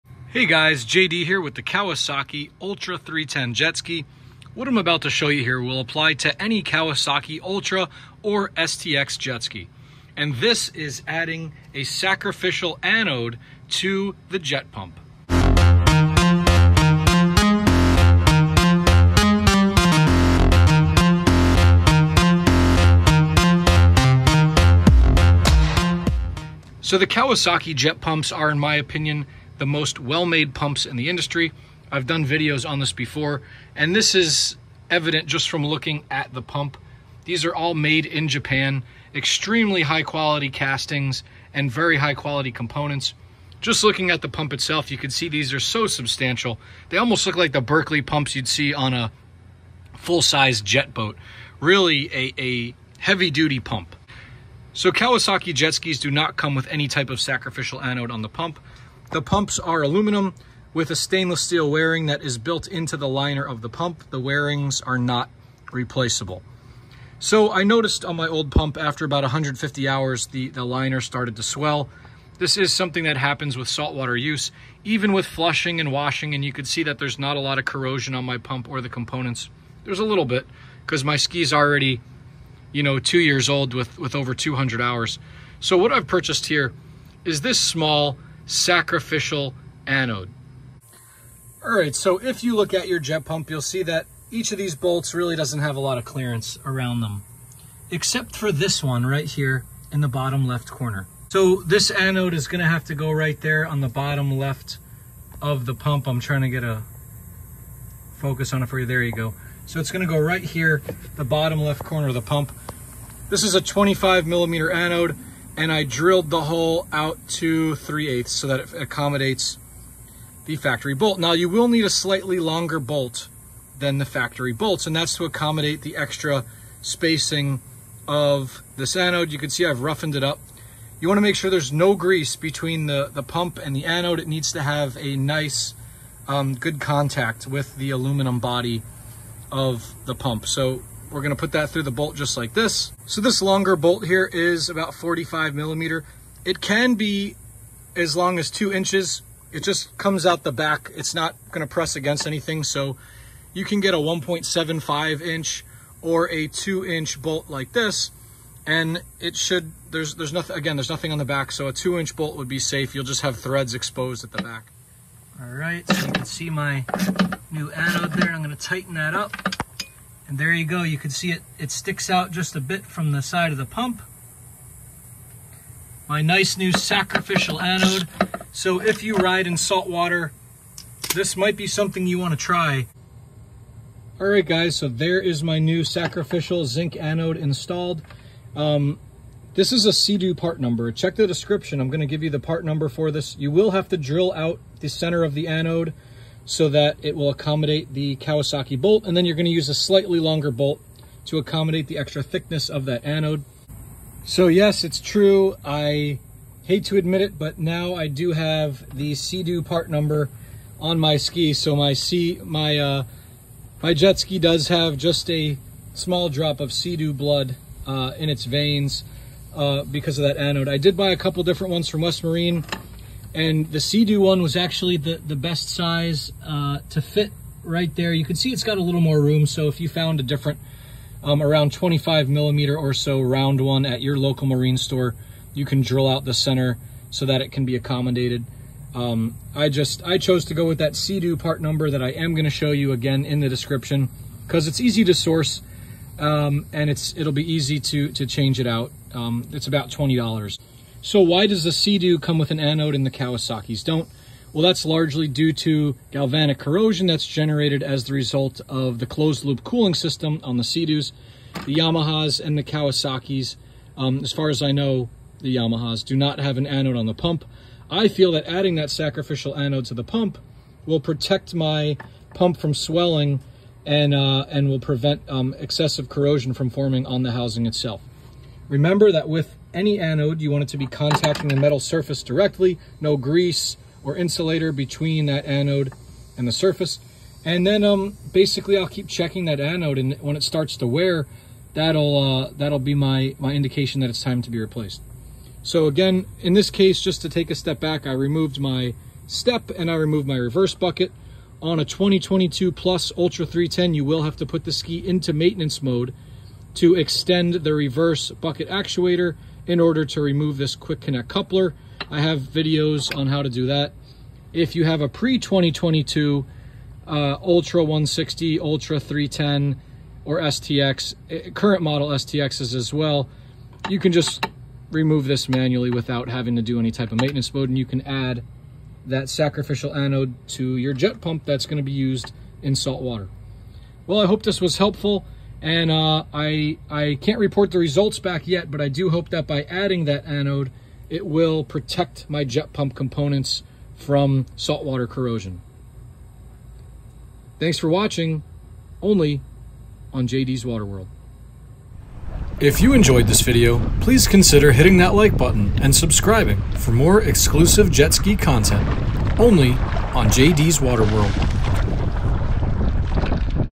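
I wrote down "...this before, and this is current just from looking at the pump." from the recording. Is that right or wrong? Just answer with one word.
wrong.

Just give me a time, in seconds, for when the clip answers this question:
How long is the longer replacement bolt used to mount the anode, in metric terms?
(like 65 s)
144 s.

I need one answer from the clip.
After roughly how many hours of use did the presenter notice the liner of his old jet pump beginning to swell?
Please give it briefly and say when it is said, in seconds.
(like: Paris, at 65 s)
150 hours, at 69 s.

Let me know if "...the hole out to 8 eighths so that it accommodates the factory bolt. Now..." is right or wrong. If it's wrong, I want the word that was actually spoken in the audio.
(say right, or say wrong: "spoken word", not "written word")
wrong: "3", not "8".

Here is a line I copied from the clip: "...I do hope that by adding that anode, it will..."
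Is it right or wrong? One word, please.
right.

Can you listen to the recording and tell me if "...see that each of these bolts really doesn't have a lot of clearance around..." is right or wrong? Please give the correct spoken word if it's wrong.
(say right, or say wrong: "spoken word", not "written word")
right.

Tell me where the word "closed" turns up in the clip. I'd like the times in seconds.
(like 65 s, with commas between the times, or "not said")
259 s.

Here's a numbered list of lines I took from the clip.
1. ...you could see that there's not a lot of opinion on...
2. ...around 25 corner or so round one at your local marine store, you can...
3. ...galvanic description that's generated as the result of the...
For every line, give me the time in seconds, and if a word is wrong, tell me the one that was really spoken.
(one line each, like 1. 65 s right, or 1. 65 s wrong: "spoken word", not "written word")
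1. 76 s wrong: "corrosion", not "opinion"
2. 231 s wrong: "millimeter", not "corner"
3. 256 s wrong: "corrosion", not "description".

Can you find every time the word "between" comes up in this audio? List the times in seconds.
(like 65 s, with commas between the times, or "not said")
132 s, 284 s.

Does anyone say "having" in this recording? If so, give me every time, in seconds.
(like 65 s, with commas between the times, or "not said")
326 s.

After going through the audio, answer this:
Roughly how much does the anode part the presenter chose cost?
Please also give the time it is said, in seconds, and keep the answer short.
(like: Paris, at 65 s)
$20, at 249 s.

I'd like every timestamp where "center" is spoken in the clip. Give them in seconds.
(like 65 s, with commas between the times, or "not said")
194 s, 236 s.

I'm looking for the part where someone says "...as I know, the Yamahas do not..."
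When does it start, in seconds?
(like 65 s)
264 s.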